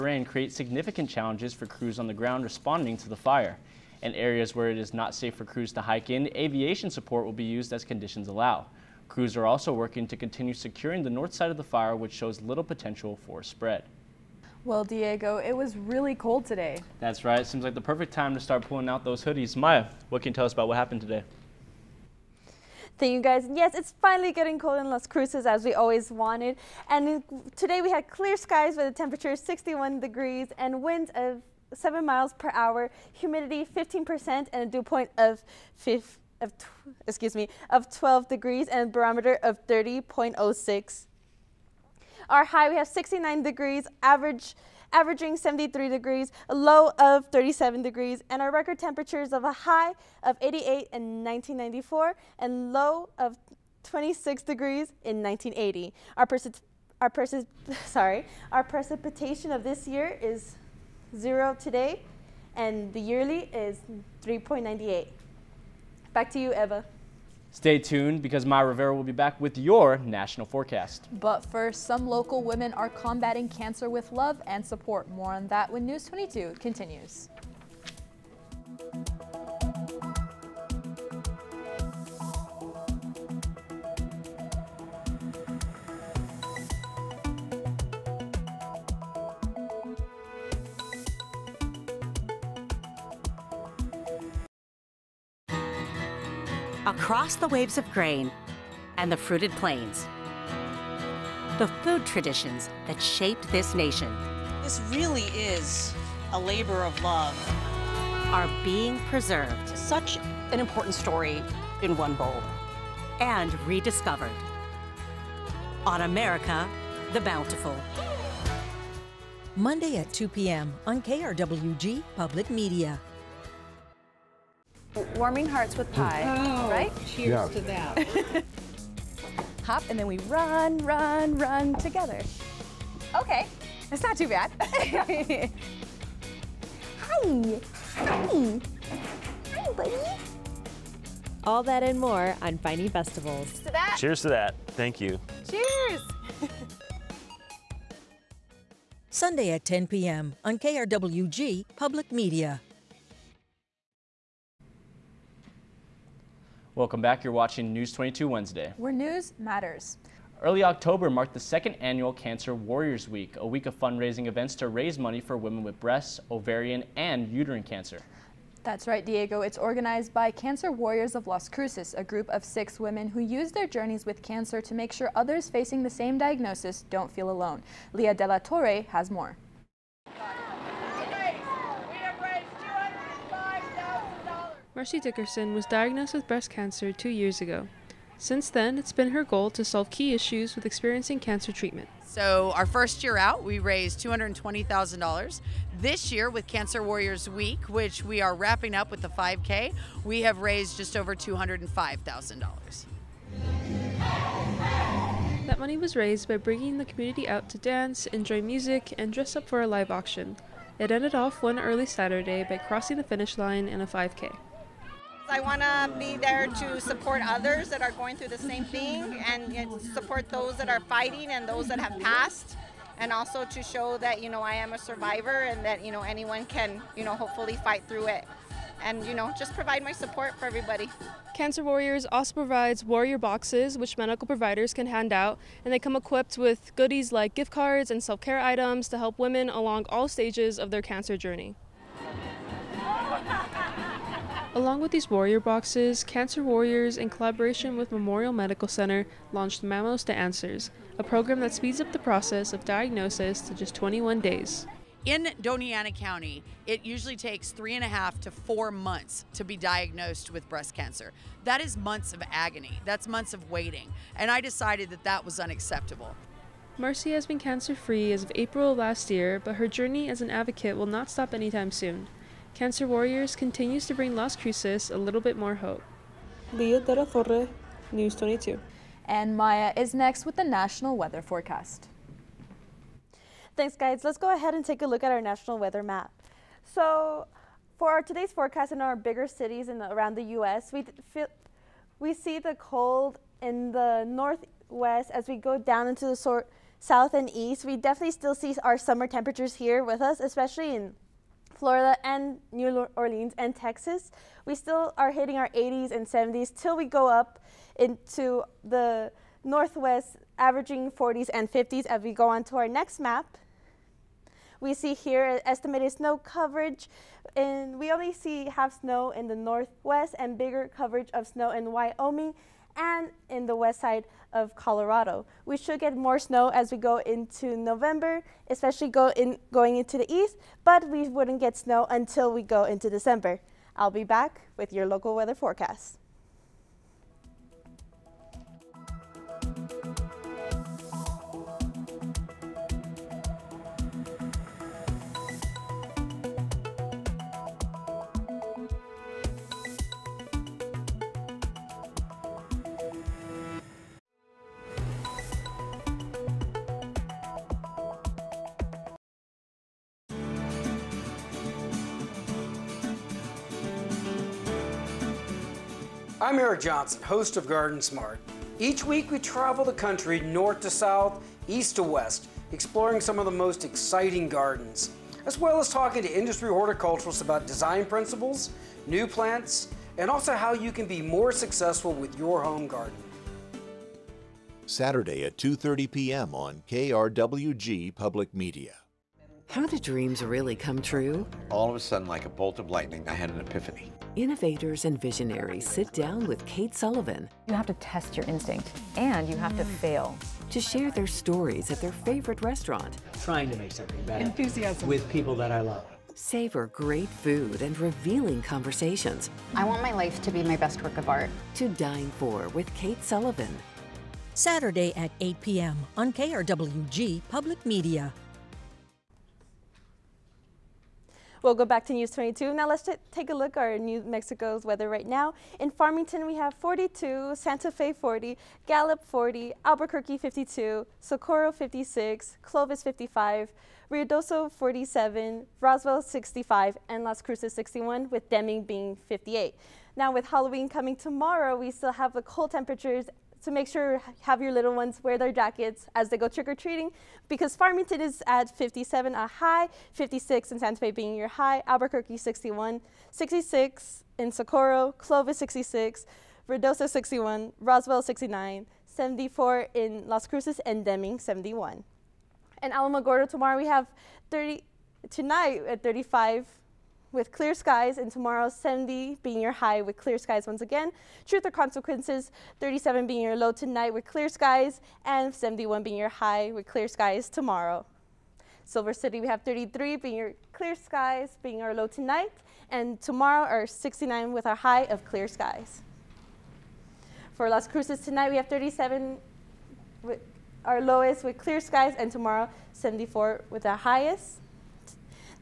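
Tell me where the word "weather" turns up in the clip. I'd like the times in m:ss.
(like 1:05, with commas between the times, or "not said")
4:40, 4:45, 5:35, 7:04.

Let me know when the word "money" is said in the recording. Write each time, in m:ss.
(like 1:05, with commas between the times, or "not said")
2:44, 3:25.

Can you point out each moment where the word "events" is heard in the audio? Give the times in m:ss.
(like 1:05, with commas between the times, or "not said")
2:44.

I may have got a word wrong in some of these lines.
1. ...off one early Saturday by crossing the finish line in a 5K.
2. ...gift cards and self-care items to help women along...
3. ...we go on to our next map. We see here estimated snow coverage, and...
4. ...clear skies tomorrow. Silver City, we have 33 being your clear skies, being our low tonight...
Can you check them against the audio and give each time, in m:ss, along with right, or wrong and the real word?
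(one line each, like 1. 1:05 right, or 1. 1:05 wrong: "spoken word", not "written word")
1. 3:31 right
2. 3:57 right
3. 5:12 right
4. 7:56 right.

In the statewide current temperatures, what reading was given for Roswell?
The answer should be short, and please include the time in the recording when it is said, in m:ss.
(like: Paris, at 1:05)
65, at 7:16.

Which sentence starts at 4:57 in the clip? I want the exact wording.
We definitely still see our summer temperatures here with us, especially in Florida and New Orleans and Texas.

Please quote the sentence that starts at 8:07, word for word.
For Las Cruces tonight, we have 37 with our lowest with clear skies, and tomorrow 74 with our highest.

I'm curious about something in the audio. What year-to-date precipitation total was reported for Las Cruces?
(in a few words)
3.98.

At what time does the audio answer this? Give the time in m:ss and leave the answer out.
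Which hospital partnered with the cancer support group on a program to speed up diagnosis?
4:07.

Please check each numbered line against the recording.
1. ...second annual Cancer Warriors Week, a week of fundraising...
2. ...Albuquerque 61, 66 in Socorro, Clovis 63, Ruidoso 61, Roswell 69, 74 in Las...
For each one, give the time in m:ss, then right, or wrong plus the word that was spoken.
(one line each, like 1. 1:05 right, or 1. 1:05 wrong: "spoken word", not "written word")
1. 2:41 right
2. 7:31 wrong: "66", not "63".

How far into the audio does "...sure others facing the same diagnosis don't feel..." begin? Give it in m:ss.
2:54.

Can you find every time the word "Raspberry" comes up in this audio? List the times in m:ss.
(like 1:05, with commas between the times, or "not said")
not said.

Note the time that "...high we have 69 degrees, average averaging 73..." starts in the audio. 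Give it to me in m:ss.
0:42.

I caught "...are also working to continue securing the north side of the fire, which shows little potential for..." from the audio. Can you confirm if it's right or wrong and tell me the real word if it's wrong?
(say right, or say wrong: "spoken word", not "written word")
right.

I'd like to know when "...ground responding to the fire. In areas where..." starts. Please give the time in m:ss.
0:02.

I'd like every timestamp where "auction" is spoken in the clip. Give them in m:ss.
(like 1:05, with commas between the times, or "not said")
3:29.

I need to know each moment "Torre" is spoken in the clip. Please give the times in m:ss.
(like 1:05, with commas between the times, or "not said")
2:58, 4:37.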